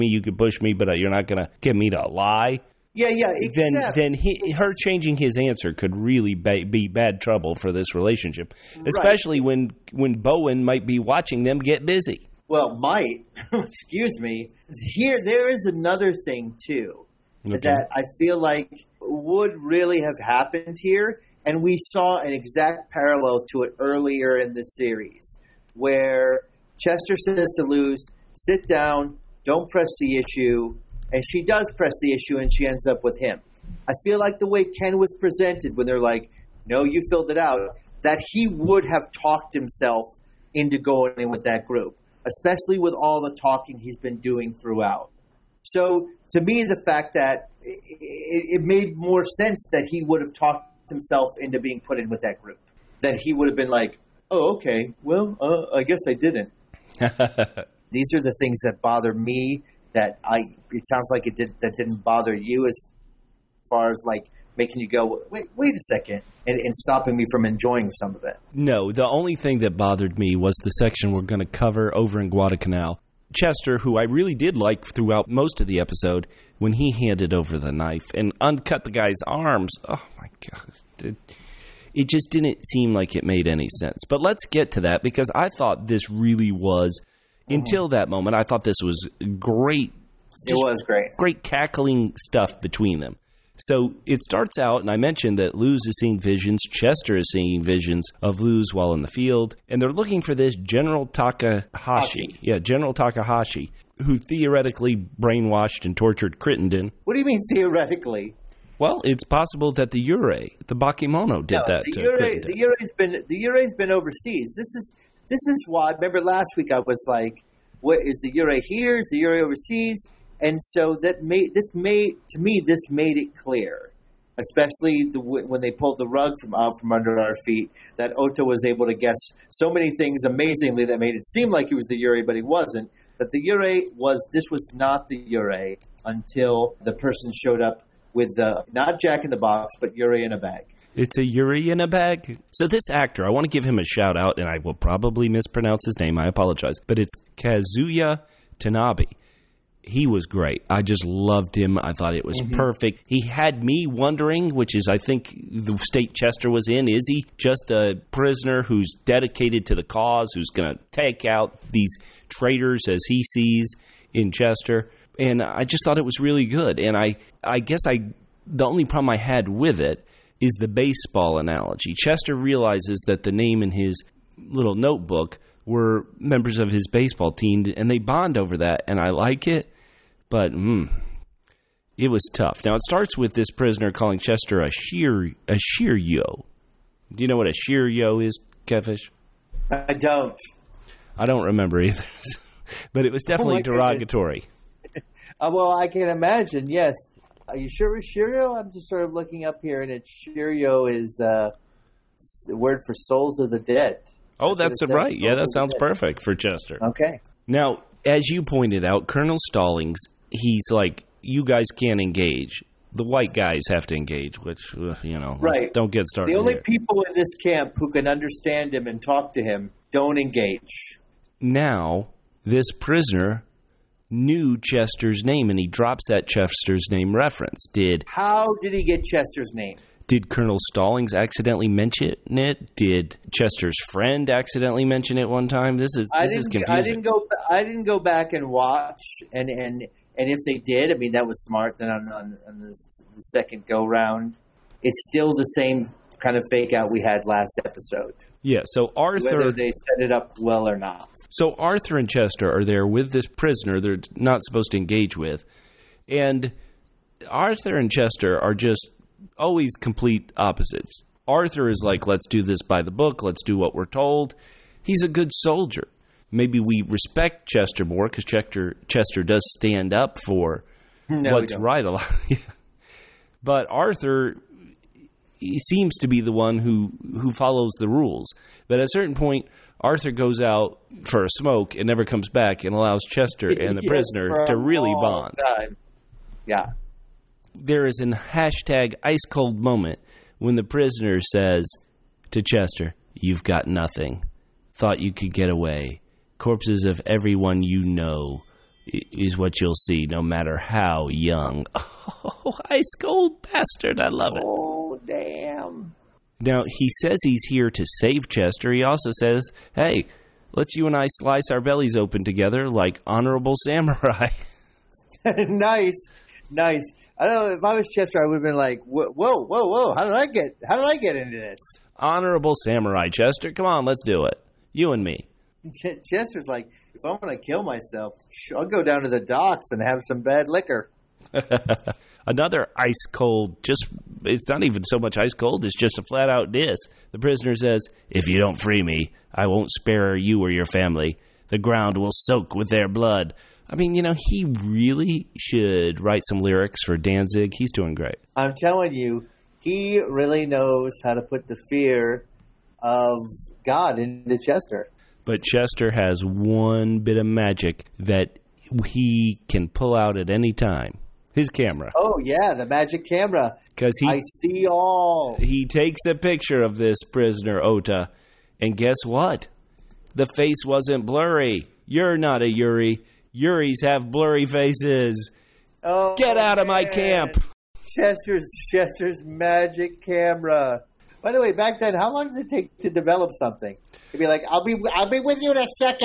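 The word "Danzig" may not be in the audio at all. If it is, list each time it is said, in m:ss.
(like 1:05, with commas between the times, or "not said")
5:46.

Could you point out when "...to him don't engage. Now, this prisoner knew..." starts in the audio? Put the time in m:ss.
3:39.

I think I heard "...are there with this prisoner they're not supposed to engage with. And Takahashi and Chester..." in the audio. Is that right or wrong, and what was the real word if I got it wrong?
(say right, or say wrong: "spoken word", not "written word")
wrong: "Arthur", not "Takahashi".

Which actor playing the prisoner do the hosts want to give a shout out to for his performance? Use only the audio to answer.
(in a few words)
Kazuya Tanabe.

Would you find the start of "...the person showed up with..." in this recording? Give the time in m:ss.
2:16.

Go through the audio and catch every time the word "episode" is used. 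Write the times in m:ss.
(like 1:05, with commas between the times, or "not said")
1:15, 4:07.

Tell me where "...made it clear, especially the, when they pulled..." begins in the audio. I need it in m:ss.
2:02.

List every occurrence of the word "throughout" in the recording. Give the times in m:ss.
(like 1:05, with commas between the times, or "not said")
0:44, 1:14.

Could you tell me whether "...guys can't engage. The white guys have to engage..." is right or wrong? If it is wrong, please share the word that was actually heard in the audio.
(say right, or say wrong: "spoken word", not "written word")
right.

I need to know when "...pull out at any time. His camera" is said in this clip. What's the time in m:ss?
5:59.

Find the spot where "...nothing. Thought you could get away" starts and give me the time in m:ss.
4:53.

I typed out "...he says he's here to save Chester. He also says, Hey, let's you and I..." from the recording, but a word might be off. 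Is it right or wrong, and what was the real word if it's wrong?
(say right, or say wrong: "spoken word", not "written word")
right.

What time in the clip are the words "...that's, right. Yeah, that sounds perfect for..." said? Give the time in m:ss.
3:24.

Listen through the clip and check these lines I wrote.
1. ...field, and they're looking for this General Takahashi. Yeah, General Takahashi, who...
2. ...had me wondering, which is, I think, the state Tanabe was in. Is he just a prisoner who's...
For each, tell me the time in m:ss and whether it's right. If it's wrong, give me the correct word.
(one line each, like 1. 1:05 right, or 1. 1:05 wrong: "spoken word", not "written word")
1. 1:39 right
2. 2:33 wrong: "Chester", not "Tanabe".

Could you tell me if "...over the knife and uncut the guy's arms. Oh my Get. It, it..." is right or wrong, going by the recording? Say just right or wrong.
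wrong.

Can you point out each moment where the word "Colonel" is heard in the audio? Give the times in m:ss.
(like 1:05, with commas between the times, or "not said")
3:29, 3:50.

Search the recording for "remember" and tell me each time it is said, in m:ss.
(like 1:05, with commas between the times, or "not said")
1:55, 3:11.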